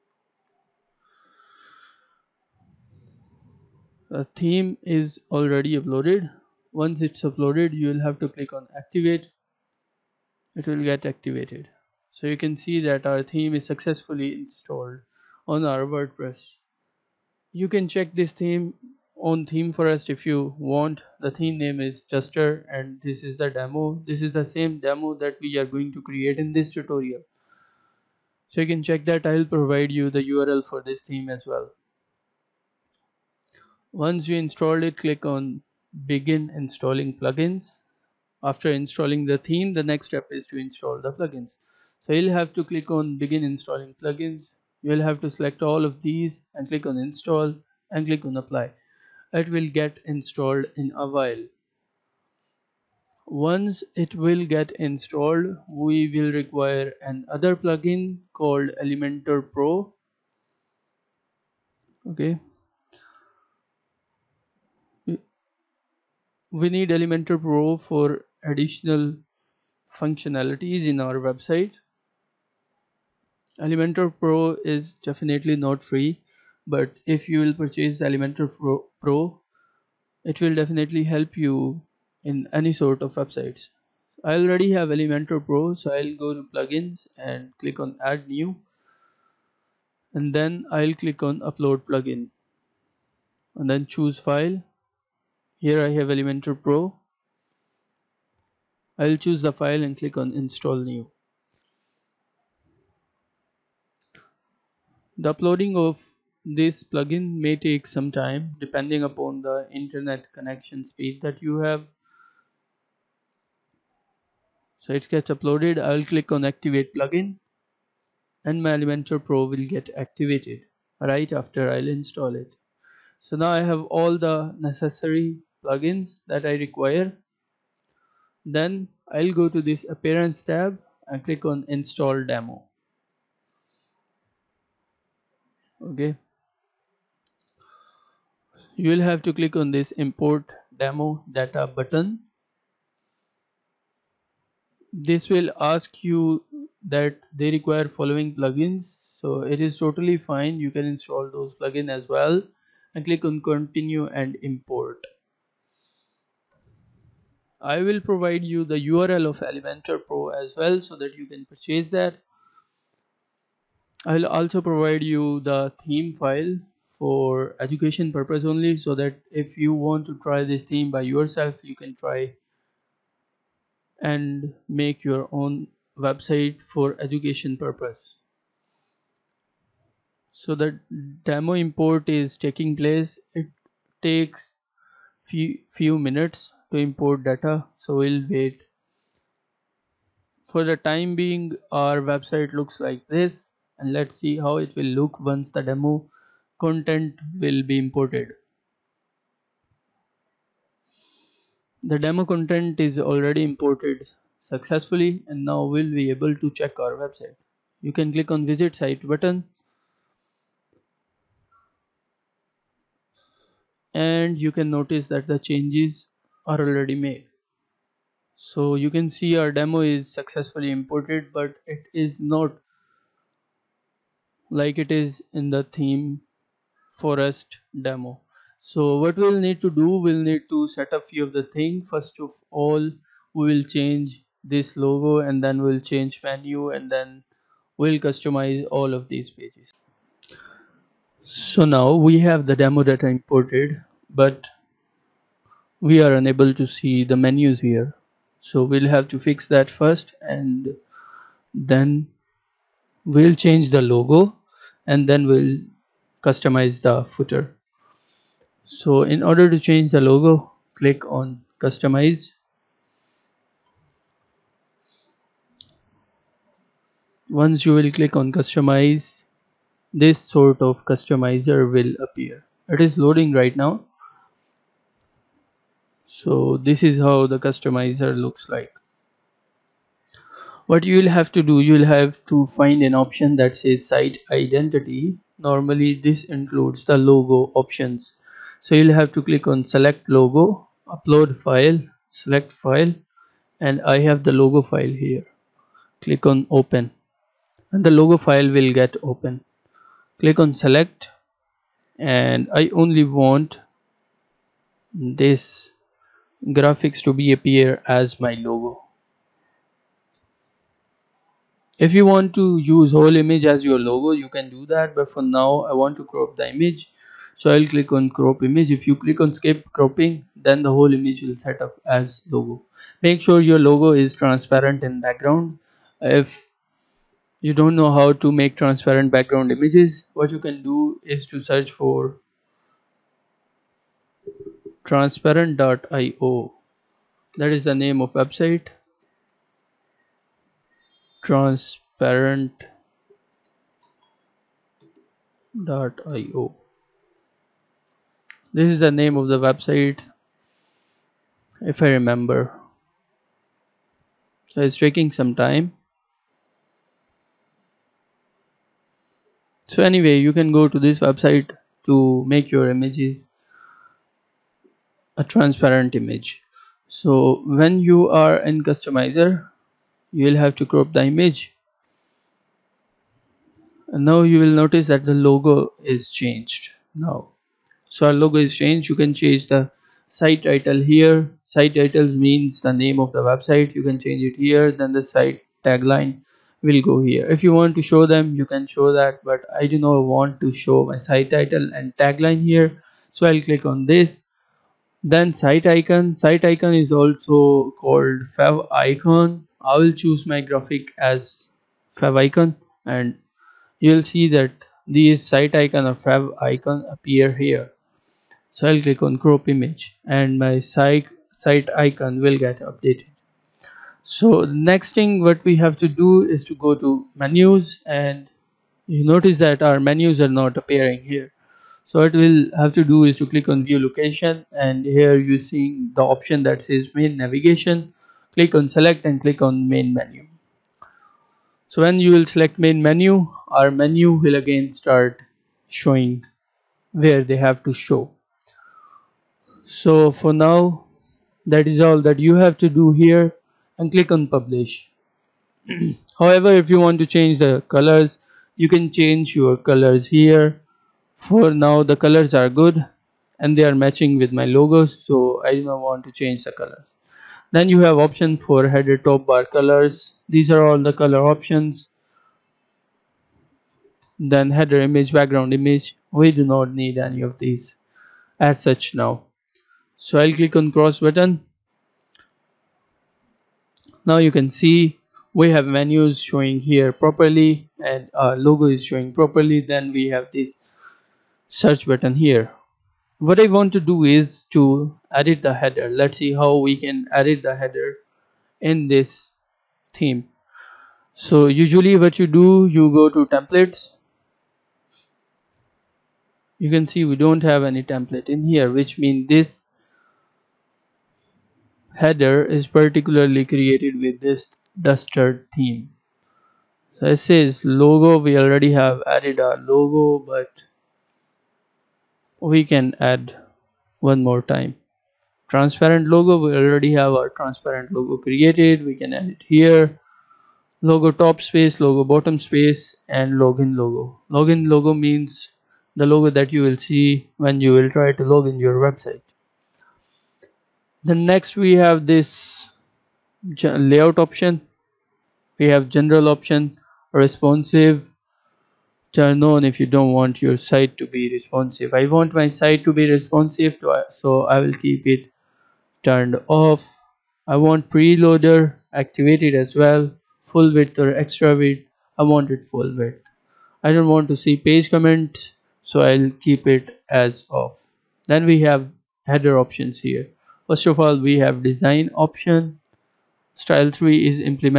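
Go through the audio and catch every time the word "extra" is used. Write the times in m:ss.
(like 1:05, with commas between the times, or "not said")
9:11.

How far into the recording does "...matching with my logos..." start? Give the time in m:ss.
7:33.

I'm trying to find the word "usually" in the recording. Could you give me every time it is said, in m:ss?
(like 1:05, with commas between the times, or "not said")
8:11.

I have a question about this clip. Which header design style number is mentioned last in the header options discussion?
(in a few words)
3.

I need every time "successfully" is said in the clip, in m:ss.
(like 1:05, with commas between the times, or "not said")
0:13, 3:24, 3:40.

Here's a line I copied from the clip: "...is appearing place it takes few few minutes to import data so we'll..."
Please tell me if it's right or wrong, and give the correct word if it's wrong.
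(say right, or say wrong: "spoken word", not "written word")
wrong: "taking", not "appearing".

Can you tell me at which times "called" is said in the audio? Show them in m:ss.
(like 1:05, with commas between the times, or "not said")
0:58, 6:37.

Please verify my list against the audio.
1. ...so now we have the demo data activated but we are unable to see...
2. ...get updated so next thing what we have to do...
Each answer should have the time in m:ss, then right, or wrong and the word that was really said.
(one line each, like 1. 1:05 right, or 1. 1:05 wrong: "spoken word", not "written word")
1. 4:01 wrong: "imported", not "activated"
2. 6:52 right.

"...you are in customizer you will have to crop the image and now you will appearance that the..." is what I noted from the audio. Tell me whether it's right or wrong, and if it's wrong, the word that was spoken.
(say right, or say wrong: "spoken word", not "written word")
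wrong: "notice", not "appearance".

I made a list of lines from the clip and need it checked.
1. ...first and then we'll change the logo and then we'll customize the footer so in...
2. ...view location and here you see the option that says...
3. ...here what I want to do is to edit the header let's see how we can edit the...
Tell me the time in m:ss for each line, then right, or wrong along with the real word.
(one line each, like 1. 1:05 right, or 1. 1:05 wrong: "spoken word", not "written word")
1. 4:09 right
2. 7:03 right
3. 8:02 right.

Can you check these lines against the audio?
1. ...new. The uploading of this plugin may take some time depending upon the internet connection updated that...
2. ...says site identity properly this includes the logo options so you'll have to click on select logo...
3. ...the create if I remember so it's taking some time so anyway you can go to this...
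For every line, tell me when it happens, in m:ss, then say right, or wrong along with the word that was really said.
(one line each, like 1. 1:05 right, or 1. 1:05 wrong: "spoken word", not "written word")
1. 1:40 wrong: "speed", not "updated"
2. 4:43 wrong: "normally", not "properly"
3. 5:49 wrong: "website", not "create".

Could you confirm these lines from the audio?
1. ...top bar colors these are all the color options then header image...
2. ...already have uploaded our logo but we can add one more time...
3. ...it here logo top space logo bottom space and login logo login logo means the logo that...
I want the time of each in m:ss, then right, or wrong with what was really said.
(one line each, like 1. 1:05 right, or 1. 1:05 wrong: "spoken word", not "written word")
1. 7:39 right
2. 8:28 wrong: "added", not "uploaded"
3. 8:39 right.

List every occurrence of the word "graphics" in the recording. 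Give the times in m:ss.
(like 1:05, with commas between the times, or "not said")
5:06, 6:40.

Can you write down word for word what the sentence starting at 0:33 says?
Once you installed it, click on begin installing plugins.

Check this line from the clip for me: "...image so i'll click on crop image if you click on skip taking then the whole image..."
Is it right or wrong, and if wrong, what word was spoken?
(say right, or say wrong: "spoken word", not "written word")
wrong: "cropping", not "taking".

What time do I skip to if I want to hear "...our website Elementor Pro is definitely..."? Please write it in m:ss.
1:10.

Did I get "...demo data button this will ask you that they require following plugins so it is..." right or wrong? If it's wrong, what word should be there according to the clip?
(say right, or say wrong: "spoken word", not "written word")
right.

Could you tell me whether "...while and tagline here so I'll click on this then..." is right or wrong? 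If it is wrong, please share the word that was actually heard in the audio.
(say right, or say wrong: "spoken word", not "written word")
wrong: "title", not "while".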